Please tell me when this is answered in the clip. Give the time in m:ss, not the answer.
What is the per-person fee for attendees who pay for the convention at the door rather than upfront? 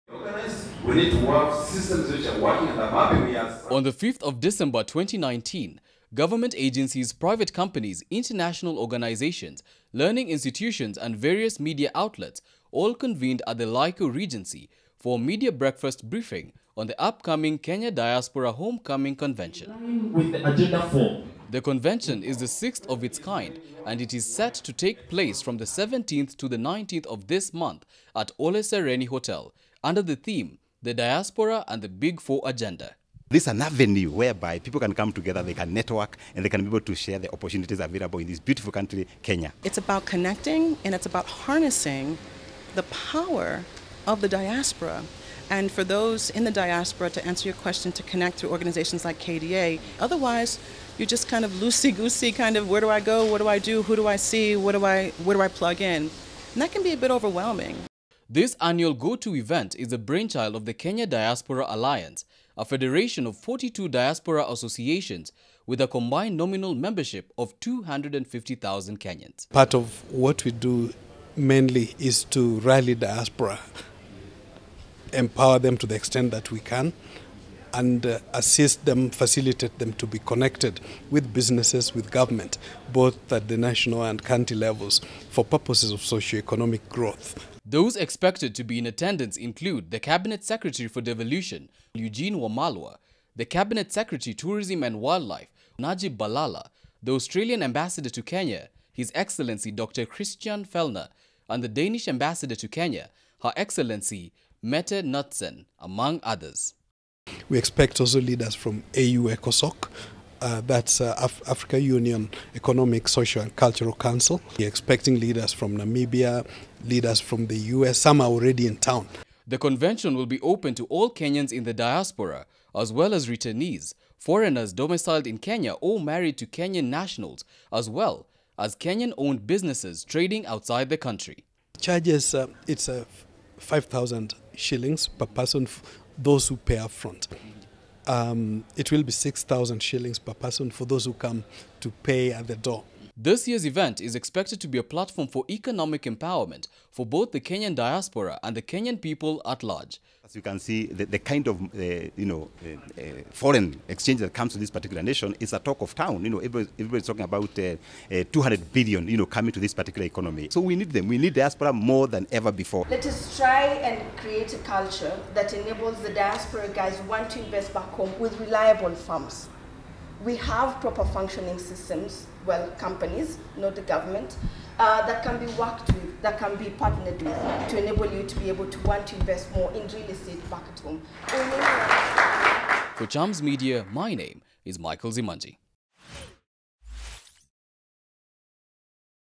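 2:19.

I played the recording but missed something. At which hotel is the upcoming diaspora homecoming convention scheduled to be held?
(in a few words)
Ole Sereni Hotel.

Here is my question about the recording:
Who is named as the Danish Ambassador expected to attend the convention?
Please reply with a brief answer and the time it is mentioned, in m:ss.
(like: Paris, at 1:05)
Mette Knudsen, at 1:44.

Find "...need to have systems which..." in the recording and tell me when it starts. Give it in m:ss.
0:00.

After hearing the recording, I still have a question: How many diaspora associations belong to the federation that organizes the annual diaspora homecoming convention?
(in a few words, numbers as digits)
42.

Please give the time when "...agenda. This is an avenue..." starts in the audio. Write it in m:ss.
0:32.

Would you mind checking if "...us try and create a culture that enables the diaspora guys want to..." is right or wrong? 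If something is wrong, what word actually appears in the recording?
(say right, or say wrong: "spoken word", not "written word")
right.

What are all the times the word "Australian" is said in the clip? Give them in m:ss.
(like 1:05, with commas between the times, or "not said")
1:37.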